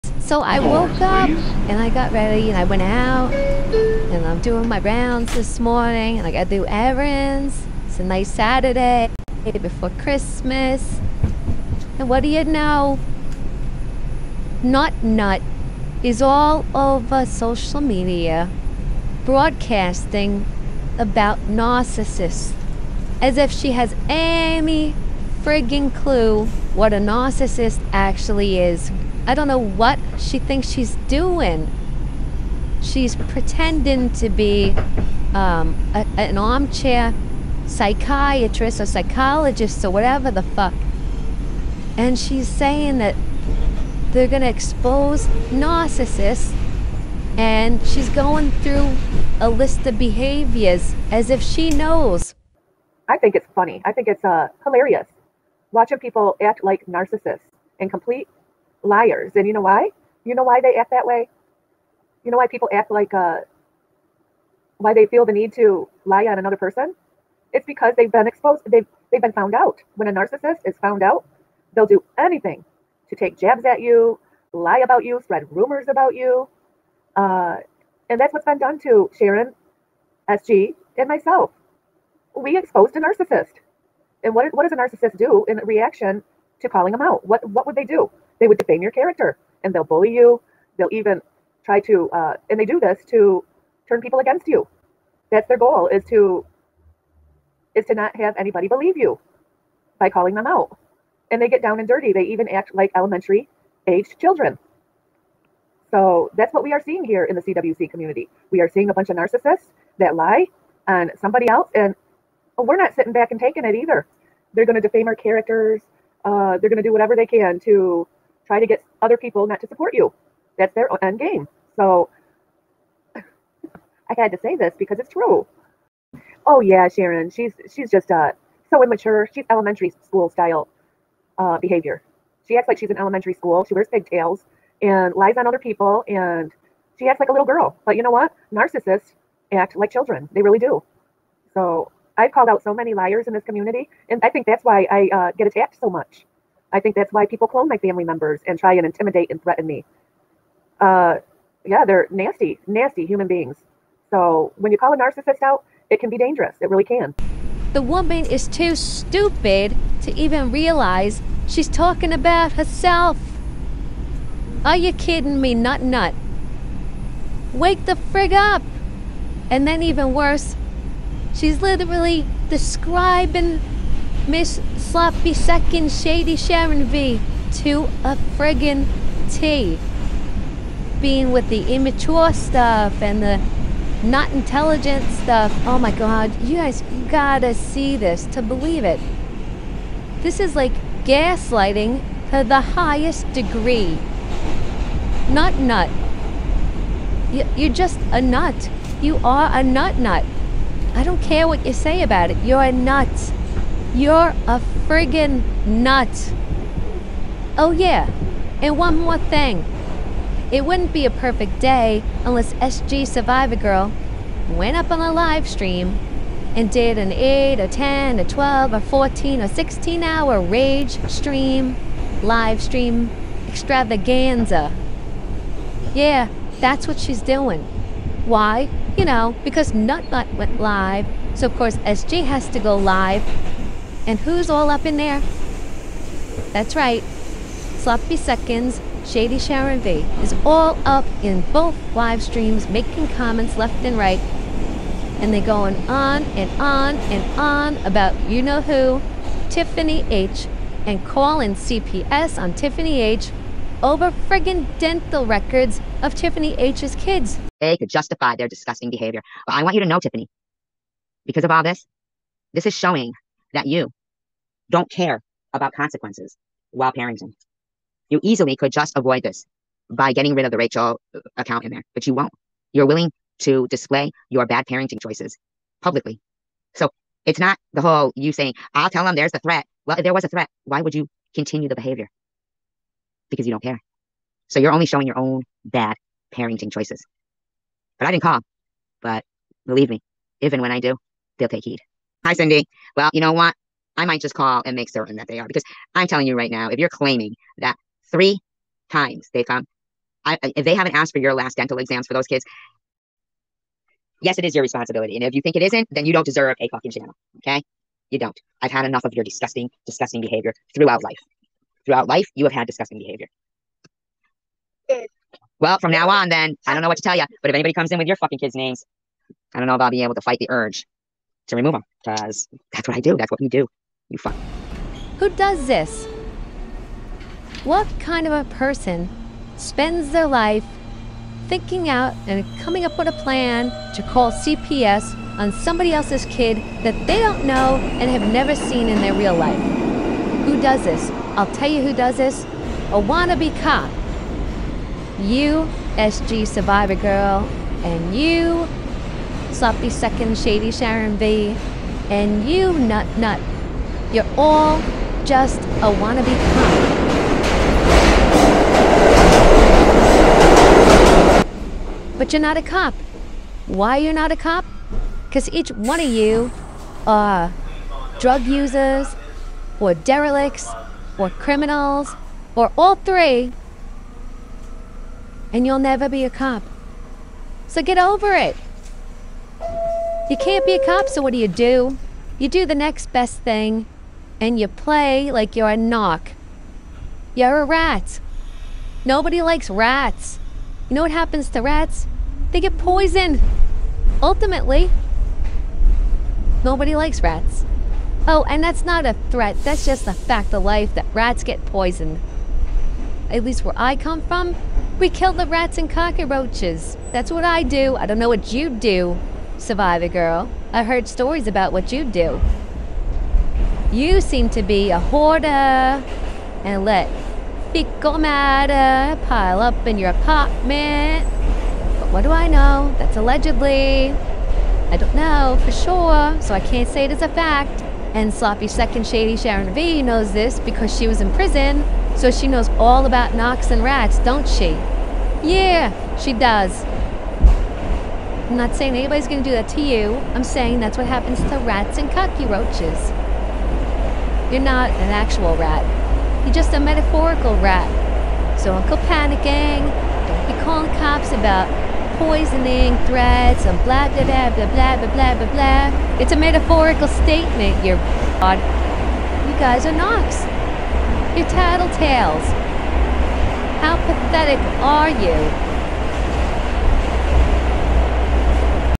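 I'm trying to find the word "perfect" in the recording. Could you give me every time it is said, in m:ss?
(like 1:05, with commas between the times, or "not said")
3:31.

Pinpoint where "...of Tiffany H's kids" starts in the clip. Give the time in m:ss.
4:16.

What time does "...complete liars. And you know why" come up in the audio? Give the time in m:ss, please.
0:57.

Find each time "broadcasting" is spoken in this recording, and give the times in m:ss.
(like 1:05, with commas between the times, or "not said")
0:19.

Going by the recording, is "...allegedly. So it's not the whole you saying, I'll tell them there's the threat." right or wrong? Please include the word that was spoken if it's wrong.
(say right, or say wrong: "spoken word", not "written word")
wrong: "publicly", not "allegedly".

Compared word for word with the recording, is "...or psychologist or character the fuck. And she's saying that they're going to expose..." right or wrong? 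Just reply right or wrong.
wrong.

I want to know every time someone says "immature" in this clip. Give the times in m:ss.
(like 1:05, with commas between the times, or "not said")
2:08, 3:01.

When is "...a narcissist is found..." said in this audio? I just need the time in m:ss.
1:10.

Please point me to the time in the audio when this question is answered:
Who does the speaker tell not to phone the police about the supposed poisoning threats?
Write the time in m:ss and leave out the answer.
7:28.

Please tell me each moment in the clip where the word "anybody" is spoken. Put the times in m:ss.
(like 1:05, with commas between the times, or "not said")
1:38, 5:17, 7:18.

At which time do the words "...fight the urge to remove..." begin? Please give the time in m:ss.
5:20.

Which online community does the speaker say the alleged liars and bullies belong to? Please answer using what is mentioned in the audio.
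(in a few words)
CWC community.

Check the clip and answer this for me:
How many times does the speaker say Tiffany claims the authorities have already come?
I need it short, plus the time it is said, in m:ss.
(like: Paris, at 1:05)
3 times, at 4:58.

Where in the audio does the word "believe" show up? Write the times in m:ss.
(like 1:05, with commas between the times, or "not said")
1:38, 3:08, 4:49.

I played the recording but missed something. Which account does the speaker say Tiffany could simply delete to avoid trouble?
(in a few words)
Rachel.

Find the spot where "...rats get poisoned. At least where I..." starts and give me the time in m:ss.
6:41.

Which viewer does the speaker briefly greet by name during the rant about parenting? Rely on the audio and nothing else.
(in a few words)
Cindy.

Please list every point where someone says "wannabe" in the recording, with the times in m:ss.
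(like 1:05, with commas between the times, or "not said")
5:42, 5:56.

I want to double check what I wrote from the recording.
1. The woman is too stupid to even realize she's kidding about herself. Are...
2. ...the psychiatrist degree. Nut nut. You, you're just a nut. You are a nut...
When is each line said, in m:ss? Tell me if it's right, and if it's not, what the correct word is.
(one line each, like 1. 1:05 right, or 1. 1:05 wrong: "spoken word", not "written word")
1. 2:37 wrong: "talking", not "kidding"
2. 3:12 wrong: "highest", not "psychiatrist".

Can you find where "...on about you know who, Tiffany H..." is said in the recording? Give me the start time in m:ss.
4:07.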